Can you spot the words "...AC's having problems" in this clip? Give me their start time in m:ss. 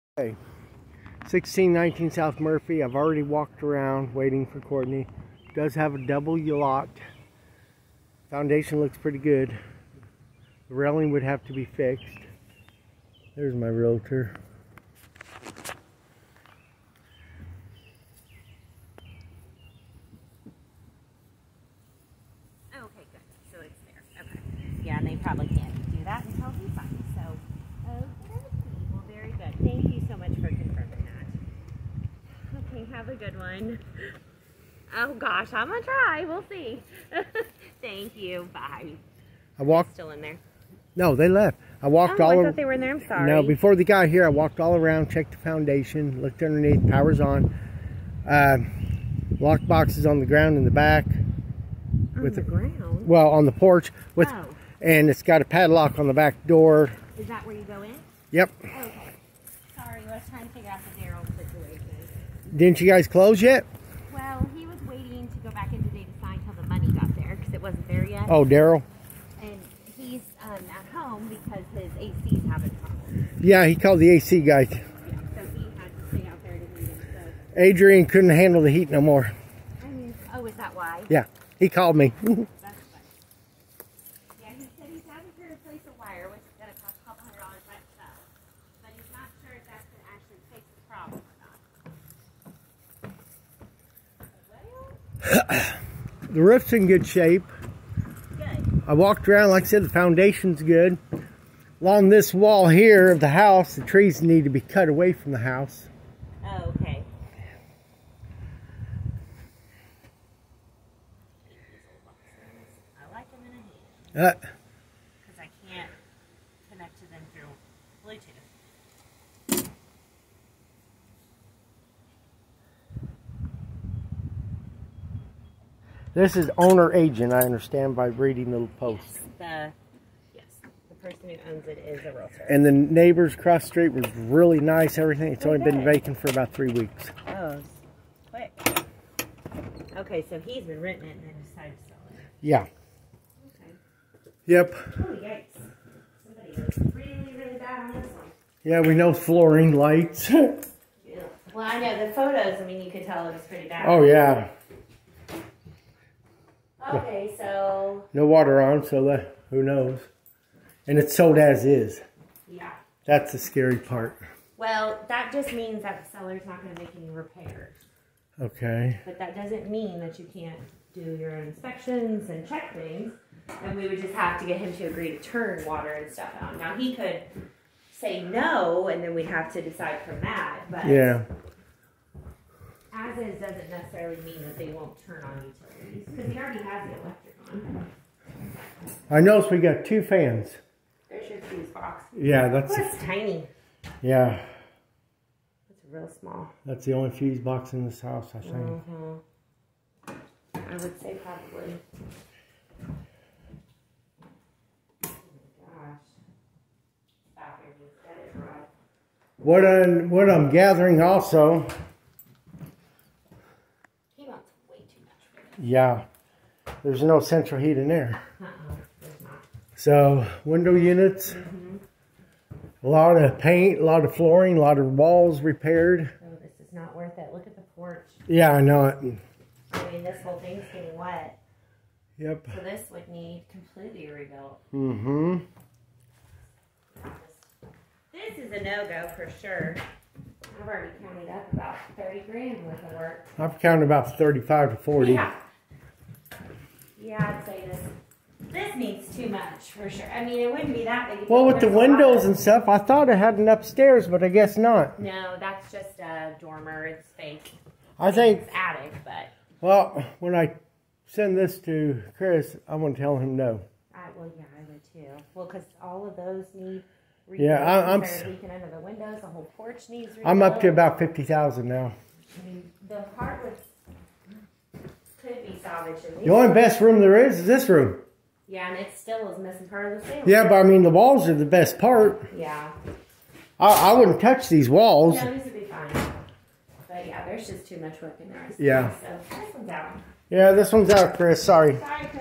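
1:11.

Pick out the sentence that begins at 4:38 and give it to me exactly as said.
Yeah, and it still is missing part of the ceiling.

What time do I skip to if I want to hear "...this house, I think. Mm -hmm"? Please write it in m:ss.
3:17.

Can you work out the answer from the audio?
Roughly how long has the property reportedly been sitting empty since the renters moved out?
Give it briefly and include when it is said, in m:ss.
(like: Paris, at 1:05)
about three weeks, at 2:16.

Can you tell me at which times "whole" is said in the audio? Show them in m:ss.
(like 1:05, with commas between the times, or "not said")
3:50, 4:29.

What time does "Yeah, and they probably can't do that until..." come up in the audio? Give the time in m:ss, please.
0:24.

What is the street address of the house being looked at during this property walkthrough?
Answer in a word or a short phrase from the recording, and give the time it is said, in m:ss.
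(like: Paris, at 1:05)
1619 South Murphy, at 0:01.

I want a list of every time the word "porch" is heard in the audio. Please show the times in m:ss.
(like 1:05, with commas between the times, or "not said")
0:53, 3:47, 4:29.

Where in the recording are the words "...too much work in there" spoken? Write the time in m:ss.
4:47.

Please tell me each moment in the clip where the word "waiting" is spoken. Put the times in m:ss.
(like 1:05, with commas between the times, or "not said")
0:04, 1:04.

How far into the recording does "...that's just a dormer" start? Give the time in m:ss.
4:15.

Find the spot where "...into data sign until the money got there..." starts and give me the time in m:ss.
1:05.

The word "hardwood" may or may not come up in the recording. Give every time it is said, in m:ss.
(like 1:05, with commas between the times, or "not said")
4:33.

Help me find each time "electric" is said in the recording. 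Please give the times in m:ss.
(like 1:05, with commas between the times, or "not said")
3:07.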